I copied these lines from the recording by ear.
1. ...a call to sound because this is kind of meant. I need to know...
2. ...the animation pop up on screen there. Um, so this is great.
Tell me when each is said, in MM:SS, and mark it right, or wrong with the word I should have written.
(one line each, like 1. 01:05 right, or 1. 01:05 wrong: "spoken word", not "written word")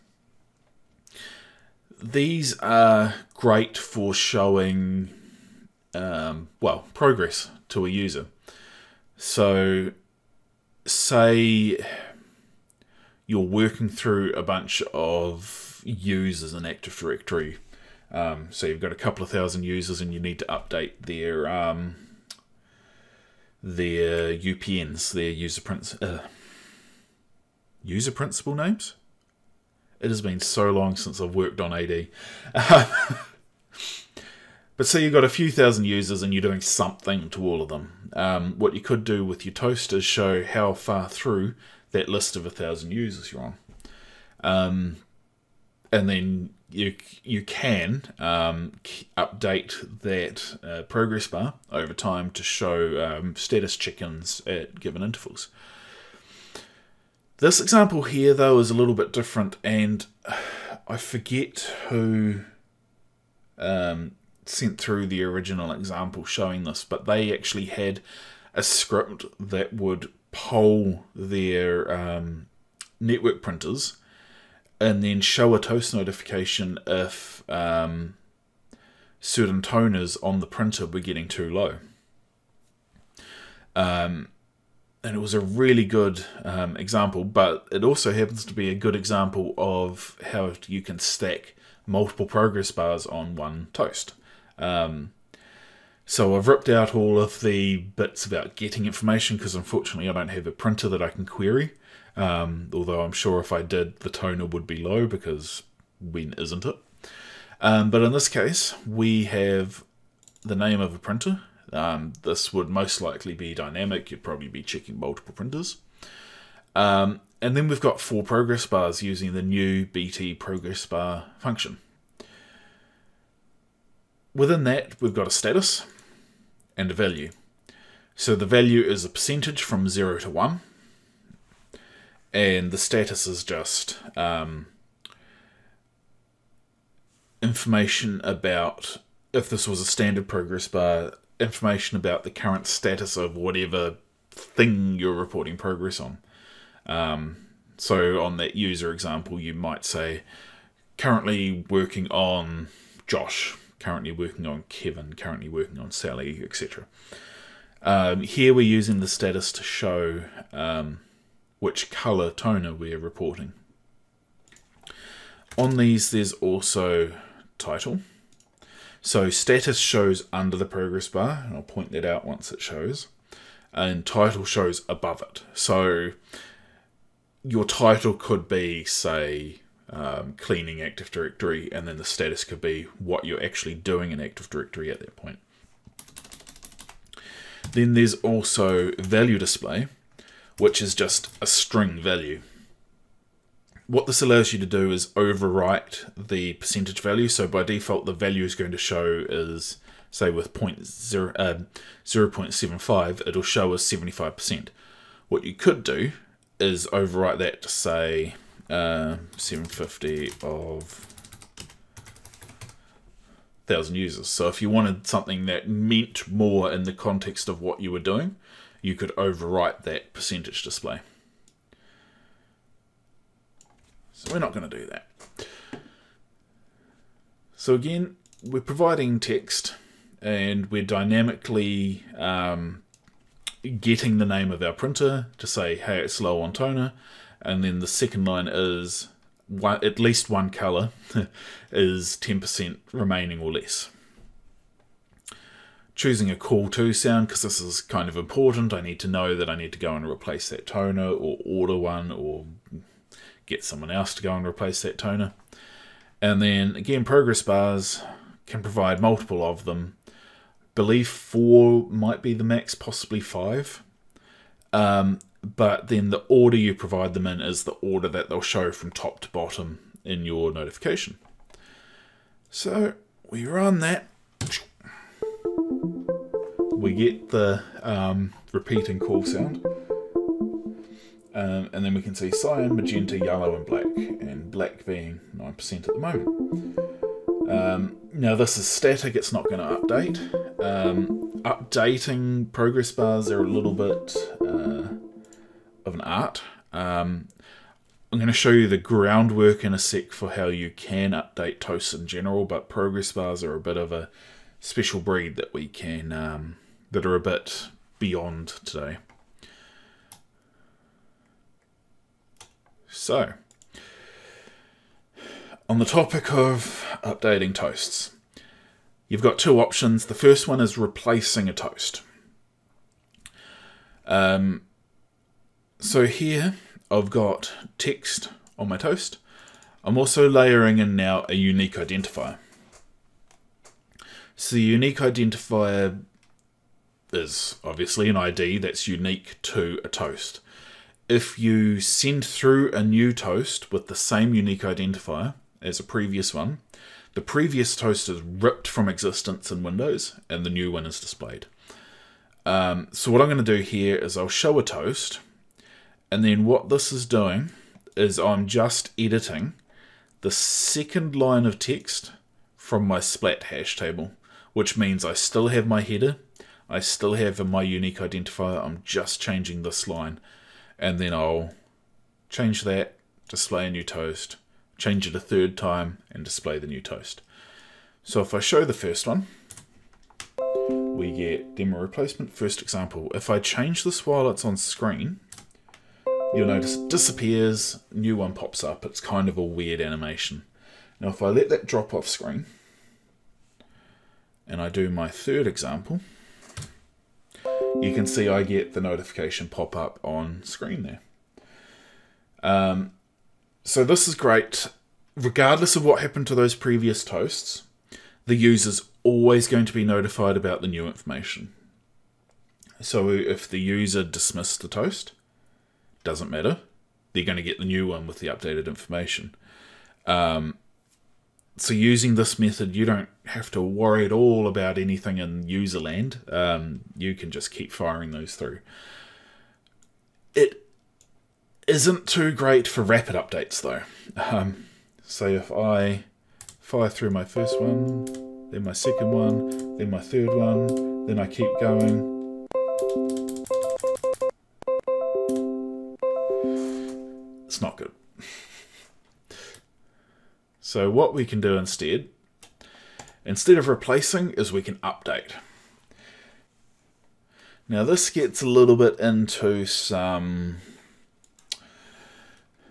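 1. 04:06 wrong: "important", not "meant"
2. 06:38 wrong: "notification", not "animation".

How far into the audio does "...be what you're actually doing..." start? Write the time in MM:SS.
03:02.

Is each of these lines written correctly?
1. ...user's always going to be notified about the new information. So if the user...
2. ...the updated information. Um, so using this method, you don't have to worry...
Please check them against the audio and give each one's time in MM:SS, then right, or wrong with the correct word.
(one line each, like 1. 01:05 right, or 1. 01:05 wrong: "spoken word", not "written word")
1. 06:48 right
2. 06:58 right.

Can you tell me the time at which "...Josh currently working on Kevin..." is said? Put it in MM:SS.
02:33.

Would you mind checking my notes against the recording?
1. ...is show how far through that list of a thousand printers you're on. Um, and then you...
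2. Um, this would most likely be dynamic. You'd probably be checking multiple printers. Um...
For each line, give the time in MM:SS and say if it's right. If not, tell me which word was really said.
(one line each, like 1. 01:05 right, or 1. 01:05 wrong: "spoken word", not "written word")
1. 00:39 wrong: "users", not "printers"
2. 01:51 right.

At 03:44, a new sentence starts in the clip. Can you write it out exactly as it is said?
So we're not going to do that.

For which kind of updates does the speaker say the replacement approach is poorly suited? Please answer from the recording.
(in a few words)
rapid updates.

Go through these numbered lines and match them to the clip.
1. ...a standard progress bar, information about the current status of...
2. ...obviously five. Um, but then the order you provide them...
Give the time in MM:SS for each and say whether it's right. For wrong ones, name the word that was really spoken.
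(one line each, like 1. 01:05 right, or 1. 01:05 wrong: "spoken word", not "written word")
1. 02:19 right
2. 04:22 wrong: "possibly", not "obviously".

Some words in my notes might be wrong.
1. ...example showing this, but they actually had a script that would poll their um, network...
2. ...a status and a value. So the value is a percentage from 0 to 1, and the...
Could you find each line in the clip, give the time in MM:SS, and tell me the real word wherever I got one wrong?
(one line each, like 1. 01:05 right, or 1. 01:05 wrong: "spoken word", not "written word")
1. 01:05 right
2. 02:05 right.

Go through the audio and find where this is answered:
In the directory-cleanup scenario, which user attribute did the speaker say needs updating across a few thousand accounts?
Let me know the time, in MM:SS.
00:27.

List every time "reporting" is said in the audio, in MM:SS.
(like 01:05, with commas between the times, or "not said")
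02:25, 02:42.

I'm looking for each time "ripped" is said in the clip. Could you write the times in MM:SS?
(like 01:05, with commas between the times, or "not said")
01:36, 05:48.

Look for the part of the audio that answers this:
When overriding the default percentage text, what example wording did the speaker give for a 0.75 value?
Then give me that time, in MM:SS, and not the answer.
03:29.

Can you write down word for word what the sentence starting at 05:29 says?
I'm also layering in now a unique identifier.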